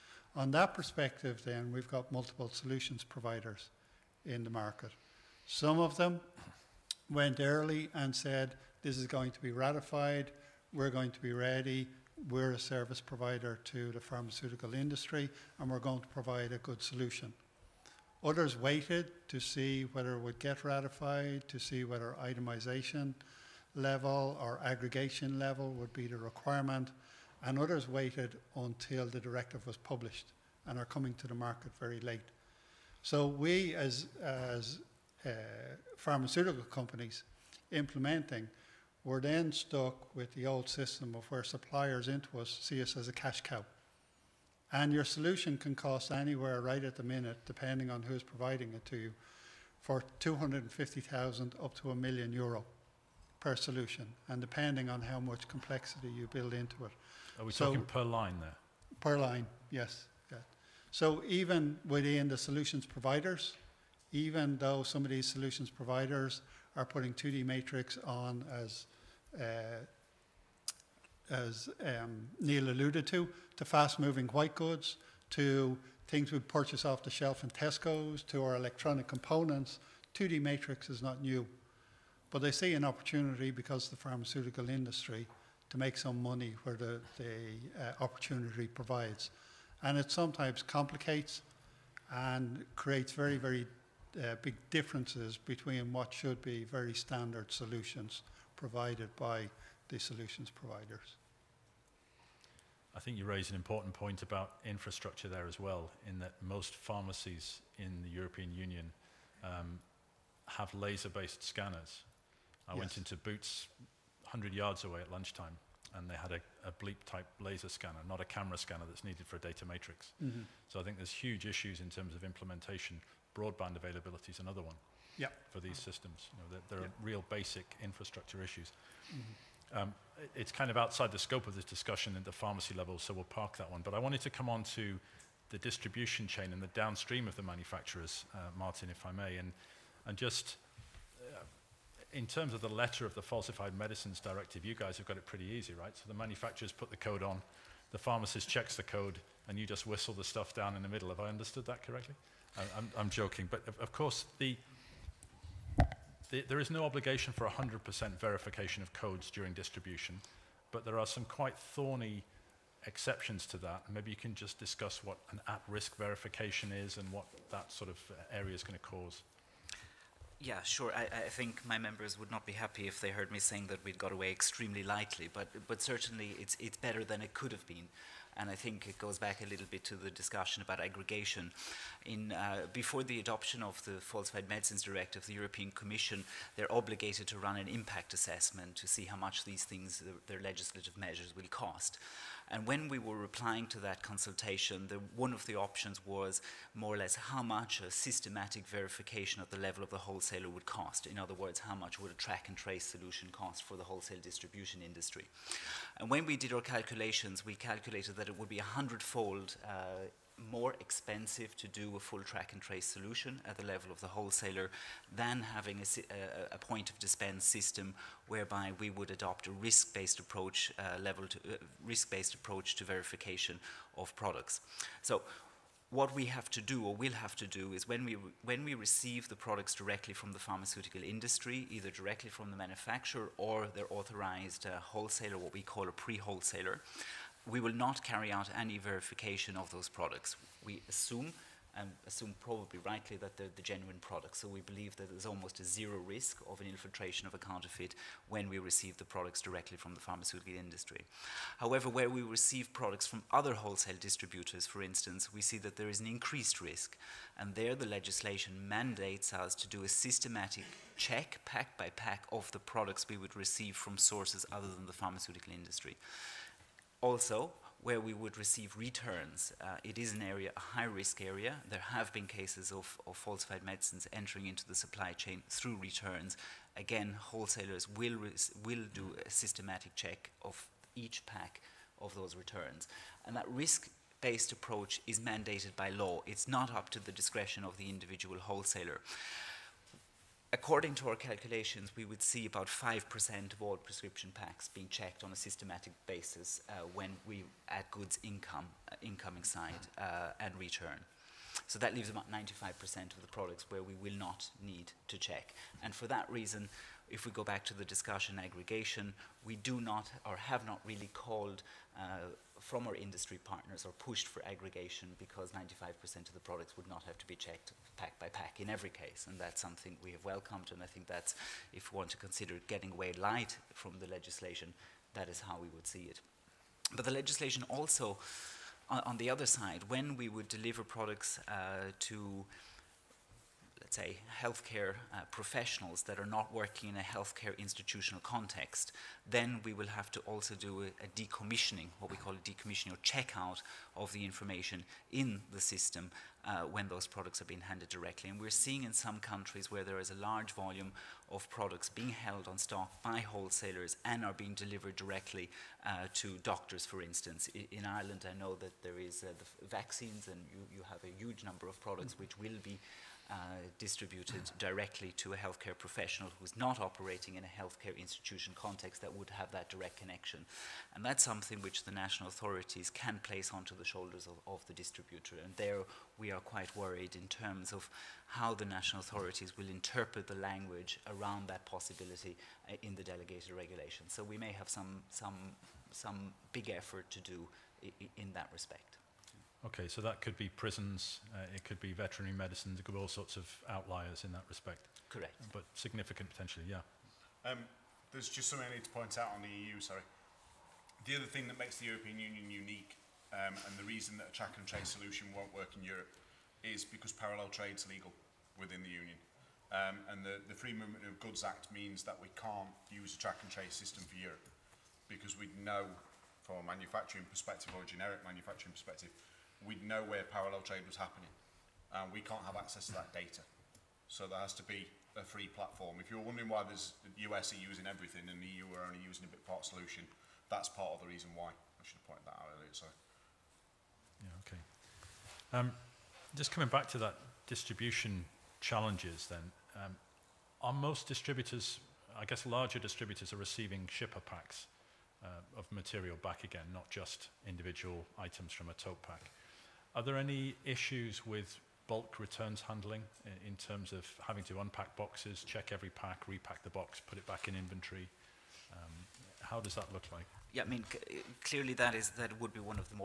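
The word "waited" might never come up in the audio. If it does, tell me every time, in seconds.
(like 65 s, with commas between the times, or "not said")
18 s, 27 s.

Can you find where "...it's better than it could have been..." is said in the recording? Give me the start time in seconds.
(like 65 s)
176 s.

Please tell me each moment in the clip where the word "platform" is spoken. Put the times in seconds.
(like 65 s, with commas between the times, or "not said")
425 s.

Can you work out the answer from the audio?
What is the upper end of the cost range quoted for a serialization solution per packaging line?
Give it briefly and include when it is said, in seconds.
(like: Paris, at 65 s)
1 million euro, at 51 s.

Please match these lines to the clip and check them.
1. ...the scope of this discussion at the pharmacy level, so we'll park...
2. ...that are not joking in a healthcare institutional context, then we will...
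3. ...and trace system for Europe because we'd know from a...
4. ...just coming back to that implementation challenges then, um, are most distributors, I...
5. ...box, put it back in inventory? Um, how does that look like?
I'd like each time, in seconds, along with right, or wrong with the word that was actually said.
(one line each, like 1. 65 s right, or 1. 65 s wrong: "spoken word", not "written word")
1. 131 s right
2. 336 s wrong: "working", not "joking"
3. 413 s right
4. 436 s wrong: "distribution", not "implementation"
5. 456 s right.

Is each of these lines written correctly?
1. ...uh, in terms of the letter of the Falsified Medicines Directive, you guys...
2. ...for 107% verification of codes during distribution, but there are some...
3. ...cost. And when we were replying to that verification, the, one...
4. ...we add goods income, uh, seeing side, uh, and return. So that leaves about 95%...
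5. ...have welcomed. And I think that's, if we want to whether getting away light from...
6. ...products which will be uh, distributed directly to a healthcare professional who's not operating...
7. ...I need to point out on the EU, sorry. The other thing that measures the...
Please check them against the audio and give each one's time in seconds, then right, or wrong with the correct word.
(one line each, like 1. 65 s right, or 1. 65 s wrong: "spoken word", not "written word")
1. 141 s right
2. 157 s wrong: "100", not "107"
3. 191 s wrong: "consultation", not "verification"
4. 297 s wrong: "incoming", not "seeing"
5. 320 s wrong: "consider", not "whether"
6. 361 s right
7. 398 s wrong: "makes", not "measures".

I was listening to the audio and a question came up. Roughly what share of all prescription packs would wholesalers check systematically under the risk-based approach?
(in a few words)
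5%.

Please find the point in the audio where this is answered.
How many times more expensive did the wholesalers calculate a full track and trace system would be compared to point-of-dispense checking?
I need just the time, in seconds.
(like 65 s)
208 s.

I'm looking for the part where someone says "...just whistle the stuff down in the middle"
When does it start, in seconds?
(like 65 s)
149 s.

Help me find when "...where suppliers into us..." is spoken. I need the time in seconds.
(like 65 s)
41 s.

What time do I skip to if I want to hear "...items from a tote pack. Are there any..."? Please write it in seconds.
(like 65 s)
448 s.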